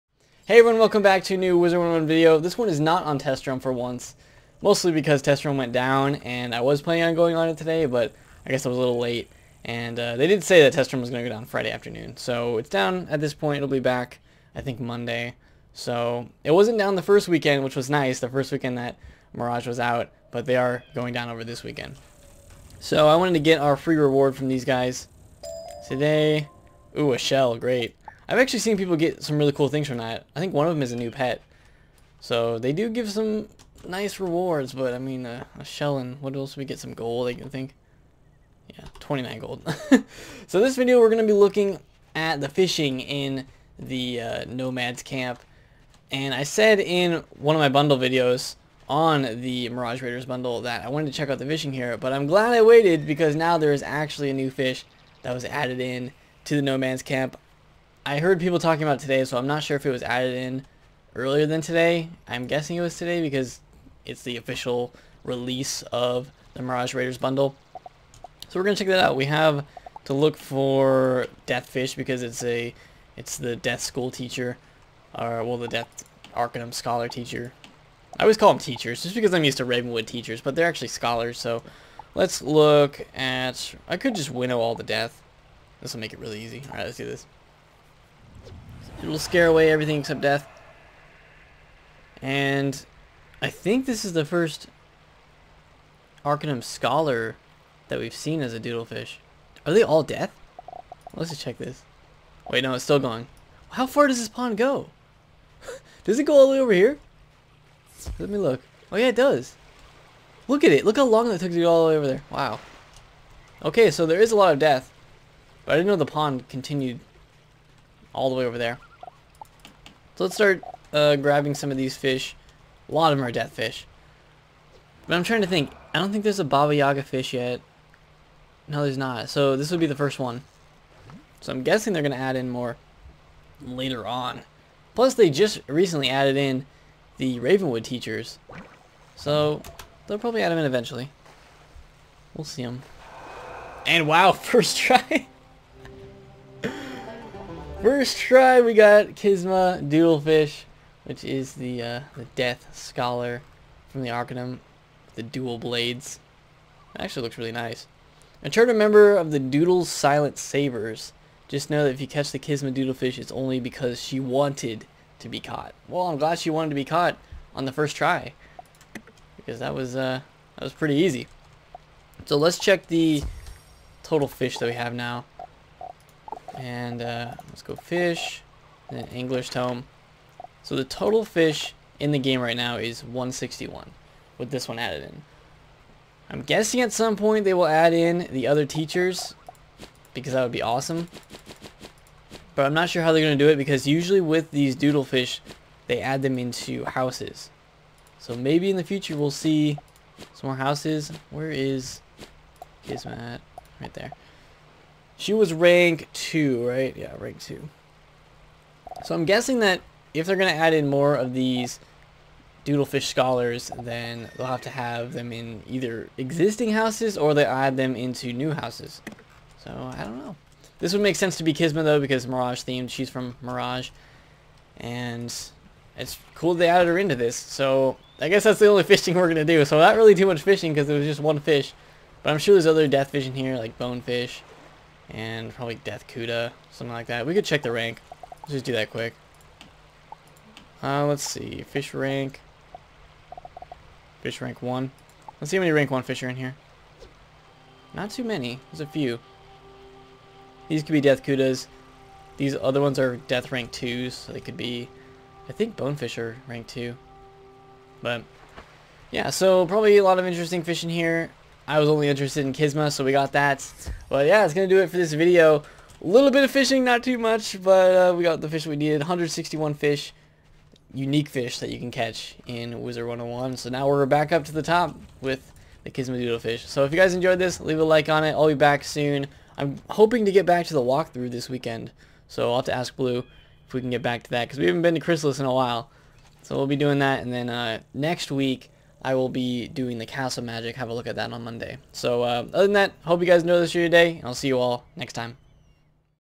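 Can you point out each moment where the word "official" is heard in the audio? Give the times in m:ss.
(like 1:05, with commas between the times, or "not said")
1:04.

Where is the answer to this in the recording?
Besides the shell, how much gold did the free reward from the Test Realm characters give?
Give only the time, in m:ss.
0:38.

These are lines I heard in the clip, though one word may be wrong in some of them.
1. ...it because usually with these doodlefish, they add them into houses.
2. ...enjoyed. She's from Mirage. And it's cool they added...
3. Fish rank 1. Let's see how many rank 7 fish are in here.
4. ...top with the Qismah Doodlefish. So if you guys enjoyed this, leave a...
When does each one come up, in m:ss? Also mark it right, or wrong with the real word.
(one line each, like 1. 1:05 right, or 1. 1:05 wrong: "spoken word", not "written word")
1. 3:13 right
2. 3:42 wrong: "themed", not "enjoyed"
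3. 4:04 wrong: "1", not "7"
4. 4:34 right.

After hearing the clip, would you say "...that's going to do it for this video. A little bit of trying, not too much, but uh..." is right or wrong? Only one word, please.
wrong.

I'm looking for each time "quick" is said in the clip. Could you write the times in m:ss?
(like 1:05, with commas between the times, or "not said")
3:58.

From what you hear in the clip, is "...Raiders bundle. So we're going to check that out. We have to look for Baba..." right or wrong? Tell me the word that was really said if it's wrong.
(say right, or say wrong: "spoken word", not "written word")
wrong: "Deathfish", not "Baba".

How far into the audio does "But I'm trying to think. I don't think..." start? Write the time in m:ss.
2:05.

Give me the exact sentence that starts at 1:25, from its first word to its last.
This will make it really easy.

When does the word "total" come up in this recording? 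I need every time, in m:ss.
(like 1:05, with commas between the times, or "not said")
2:54, 3:00.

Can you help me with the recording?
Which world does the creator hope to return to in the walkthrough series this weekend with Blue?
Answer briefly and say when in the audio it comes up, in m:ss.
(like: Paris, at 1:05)
Chrysalis, at 4:44.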